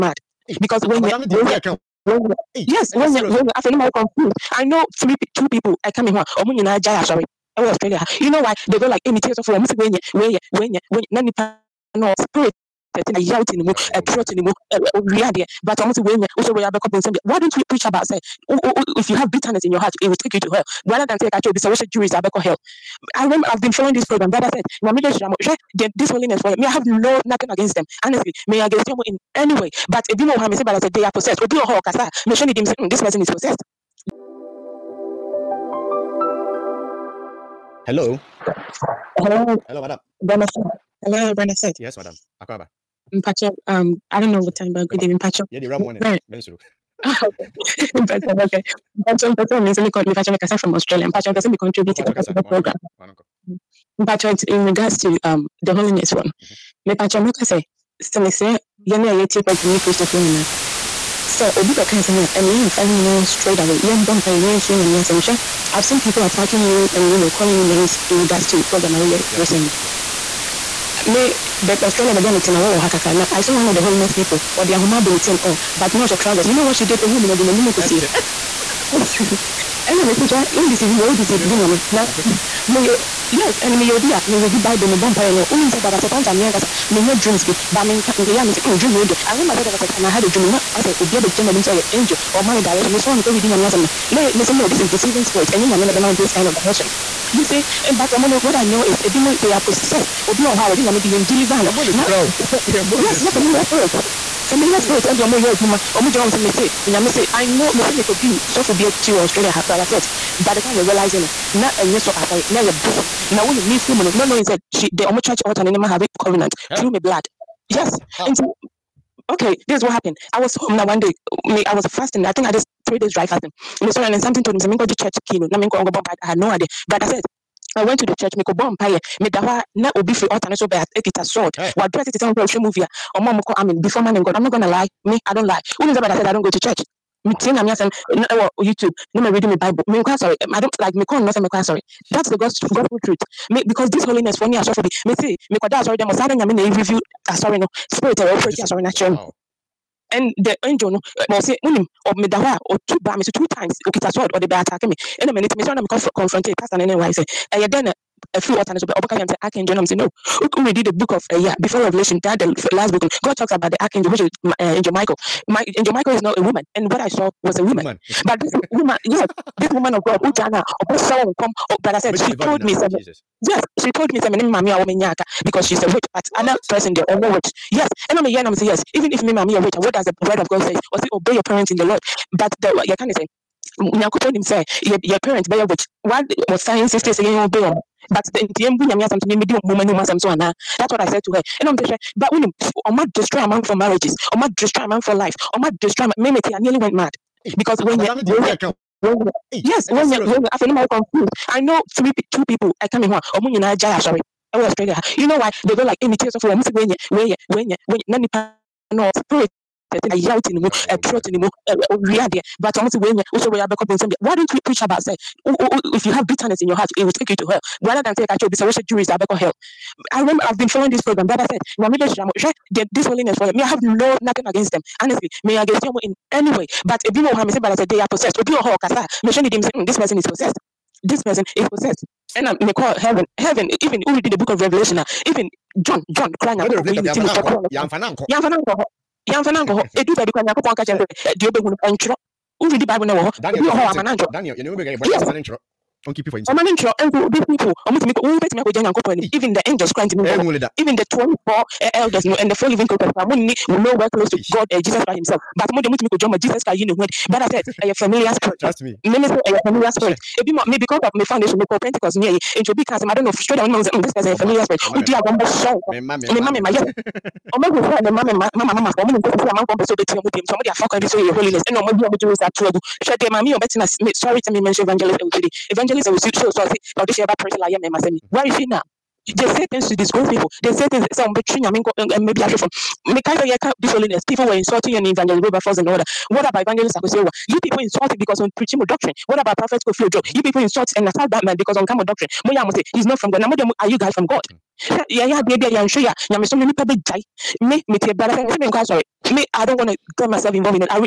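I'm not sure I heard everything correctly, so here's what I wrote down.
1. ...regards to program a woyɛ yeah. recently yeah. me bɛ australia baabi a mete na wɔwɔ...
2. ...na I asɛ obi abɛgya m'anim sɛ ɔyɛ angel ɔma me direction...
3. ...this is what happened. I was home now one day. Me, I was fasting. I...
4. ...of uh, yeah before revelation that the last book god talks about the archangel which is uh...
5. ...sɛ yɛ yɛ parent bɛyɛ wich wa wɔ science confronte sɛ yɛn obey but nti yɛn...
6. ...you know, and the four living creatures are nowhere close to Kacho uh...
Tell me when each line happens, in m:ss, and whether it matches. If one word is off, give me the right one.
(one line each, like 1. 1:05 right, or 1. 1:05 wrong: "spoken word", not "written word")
1. 1:08 right
2. 1:30 right
3. 1:59 right
4. 2:41 right
5. 3:04 wrong: "state", not "confronte"
6. 4:12 wrong: "God", not "Kacho".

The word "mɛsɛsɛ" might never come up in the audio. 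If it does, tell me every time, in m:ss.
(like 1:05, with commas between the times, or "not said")
1:20.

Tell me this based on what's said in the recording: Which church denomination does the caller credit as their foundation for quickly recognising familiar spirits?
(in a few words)
Pentecost.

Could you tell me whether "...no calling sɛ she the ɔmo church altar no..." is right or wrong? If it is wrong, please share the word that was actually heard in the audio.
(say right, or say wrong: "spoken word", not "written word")
wrong: "knowing", not "calling".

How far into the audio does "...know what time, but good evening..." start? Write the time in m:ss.
0:44.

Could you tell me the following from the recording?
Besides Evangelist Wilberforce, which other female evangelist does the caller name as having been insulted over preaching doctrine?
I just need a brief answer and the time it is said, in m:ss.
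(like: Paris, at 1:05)
Evangelist Akosewa, at 4:46.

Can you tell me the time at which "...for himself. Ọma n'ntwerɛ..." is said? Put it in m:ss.
4:06.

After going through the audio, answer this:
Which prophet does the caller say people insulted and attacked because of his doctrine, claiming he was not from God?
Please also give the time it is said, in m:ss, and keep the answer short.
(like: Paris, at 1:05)
Prophet Kofi Odo, at 4:49.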